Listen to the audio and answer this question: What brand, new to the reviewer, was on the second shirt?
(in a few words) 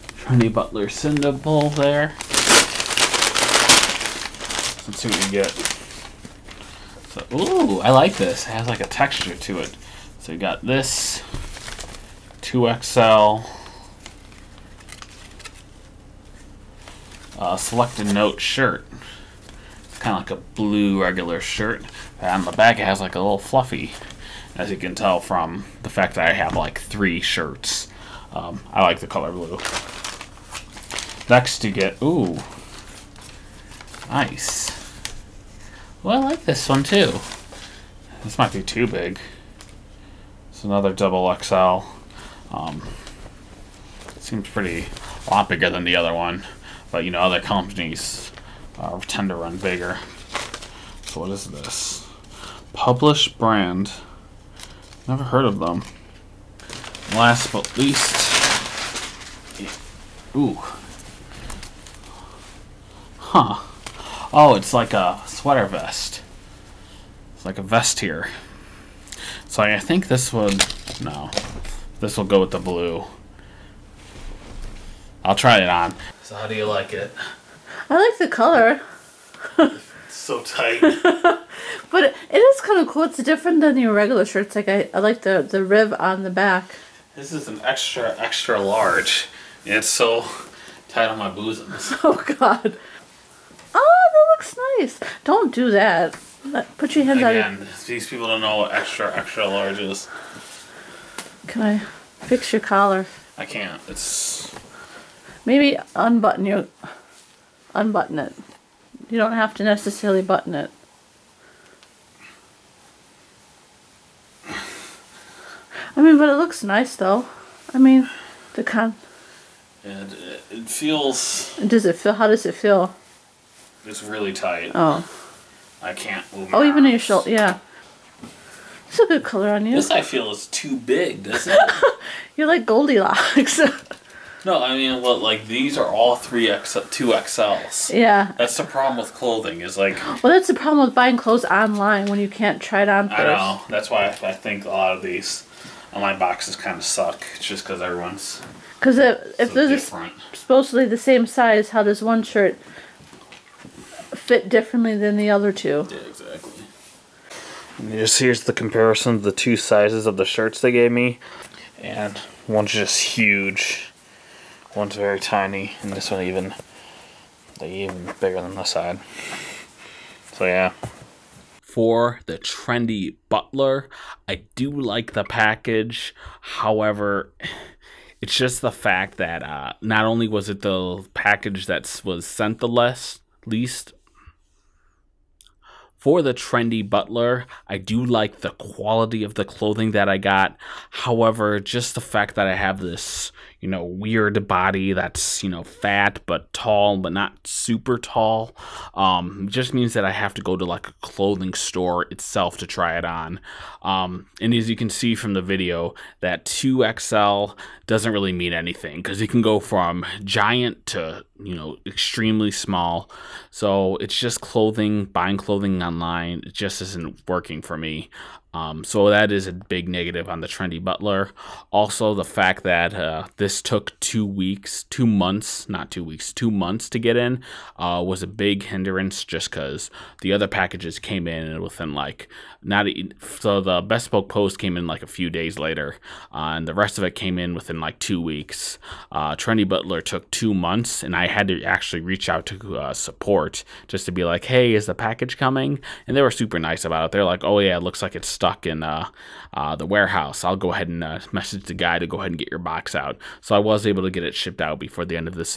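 Published brand.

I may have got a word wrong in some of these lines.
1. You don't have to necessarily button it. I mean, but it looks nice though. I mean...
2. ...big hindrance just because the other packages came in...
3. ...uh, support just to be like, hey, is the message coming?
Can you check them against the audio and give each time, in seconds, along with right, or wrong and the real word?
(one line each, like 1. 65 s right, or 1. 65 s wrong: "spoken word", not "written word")
1. 109 s right
2. 228 s right
3. 242 s wrong: "package", not "message".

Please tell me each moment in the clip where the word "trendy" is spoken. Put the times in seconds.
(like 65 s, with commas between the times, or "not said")
0 s, 172 s, 186 s, 220 s, 239 s.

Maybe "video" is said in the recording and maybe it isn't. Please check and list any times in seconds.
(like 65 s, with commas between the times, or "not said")
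205 s.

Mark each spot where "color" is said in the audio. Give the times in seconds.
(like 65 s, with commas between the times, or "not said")
29 s, 78 s, 129 s.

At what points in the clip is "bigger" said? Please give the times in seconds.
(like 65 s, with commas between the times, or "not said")
45 s, 49 s, 168 s.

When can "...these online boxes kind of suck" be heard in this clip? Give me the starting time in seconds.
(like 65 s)
145 s.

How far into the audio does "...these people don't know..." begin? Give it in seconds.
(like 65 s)
97 s.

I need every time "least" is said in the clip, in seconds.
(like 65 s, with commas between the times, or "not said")
57 s, 183 s.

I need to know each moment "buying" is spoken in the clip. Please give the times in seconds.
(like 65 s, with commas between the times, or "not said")
140 s, 215 s.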